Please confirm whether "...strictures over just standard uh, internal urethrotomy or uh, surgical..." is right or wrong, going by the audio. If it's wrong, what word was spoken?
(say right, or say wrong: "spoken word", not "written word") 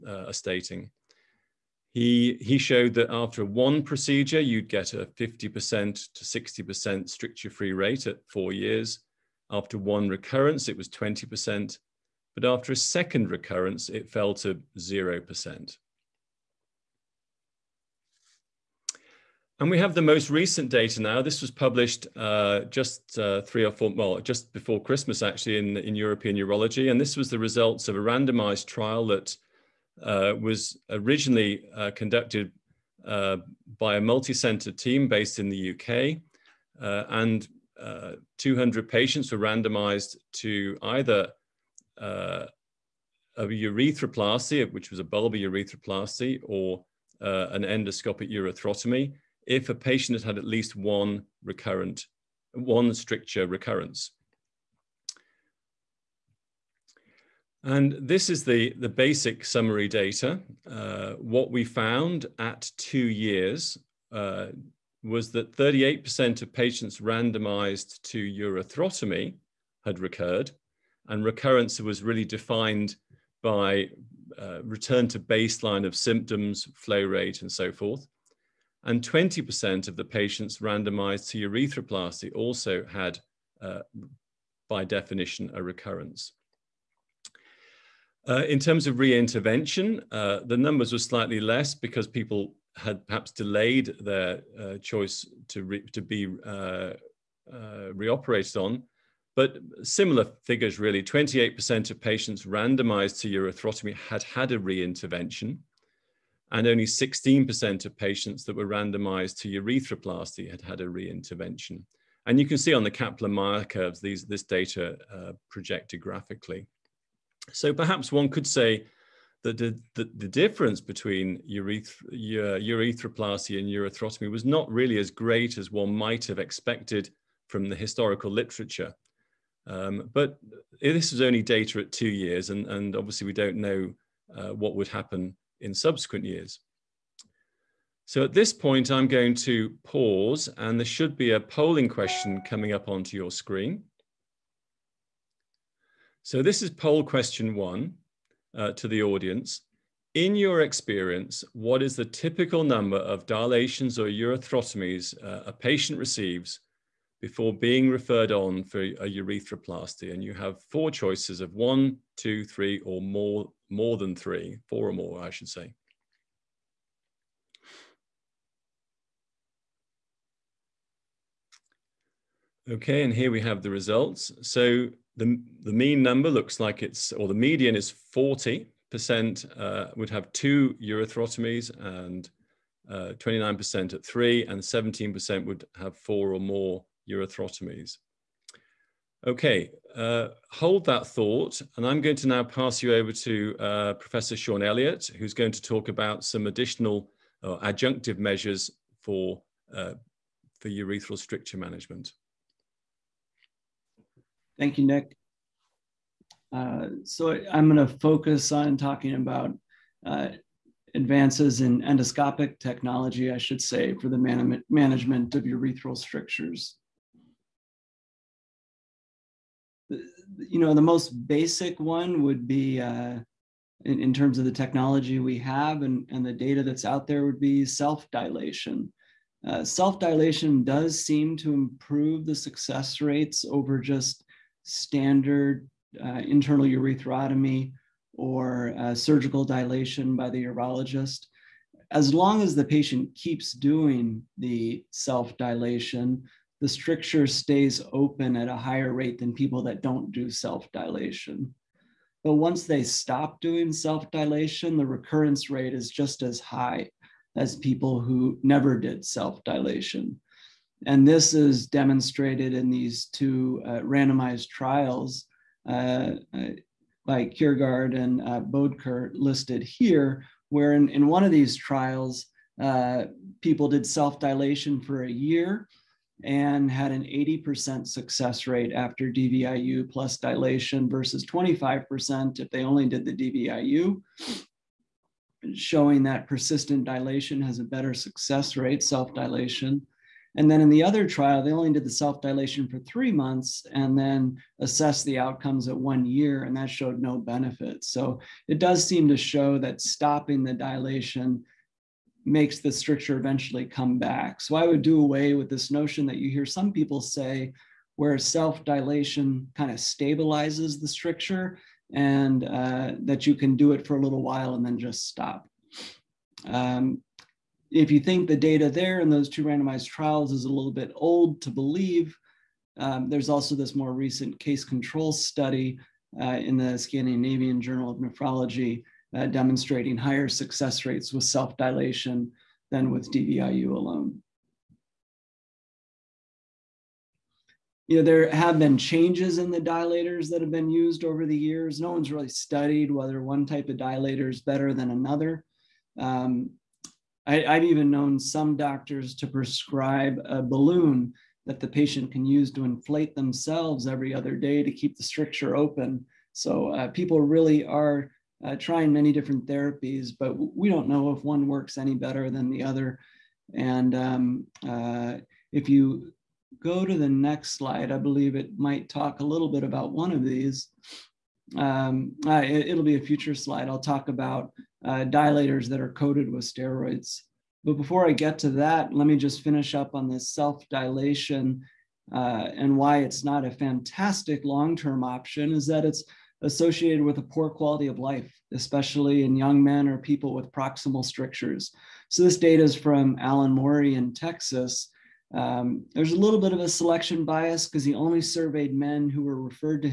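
wrong: "rates", not "strictures".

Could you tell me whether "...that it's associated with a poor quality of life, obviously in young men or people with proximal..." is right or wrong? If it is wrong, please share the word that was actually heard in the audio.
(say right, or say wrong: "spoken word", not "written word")
wrong: "especially", not "obviously".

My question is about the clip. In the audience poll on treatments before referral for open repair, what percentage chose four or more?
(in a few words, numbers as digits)
17%.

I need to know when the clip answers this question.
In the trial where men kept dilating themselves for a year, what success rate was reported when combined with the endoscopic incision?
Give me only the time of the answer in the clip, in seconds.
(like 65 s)
277 s.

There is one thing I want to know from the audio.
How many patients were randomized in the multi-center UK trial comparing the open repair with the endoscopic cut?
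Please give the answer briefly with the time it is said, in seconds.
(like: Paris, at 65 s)
200, at 38 s.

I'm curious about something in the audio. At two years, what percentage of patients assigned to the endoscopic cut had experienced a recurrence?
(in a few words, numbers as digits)
38%.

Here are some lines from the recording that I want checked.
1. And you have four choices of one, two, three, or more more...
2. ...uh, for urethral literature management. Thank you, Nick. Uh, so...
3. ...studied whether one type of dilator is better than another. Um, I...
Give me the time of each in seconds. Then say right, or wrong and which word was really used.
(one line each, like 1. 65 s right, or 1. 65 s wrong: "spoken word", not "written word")
1. 160 s right
2. 199 s wrong: "stricture", not "literature"
3. 342 s right.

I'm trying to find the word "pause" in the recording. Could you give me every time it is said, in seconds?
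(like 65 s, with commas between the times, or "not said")
139 s.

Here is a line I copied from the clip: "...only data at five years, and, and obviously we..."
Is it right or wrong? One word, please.
wrong.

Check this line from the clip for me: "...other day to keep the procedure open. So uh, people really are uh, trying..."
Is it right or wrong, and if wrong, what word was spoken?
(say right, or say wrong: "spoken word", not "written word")
wrong: "stricture", not "procedure".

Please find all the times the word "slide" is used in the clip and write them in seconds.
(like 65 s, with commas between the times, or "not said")
367 s, 373 s.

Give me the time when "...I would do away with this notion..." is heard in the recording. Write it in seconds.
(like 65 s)
304 s.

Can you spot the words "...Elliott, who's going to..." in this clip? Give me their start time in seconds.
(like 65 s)
194 s.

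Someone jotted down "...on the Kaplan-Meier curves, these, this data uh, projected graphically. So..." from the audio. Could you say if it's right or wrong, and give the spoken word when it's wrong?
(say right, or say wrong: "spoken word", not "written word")
right.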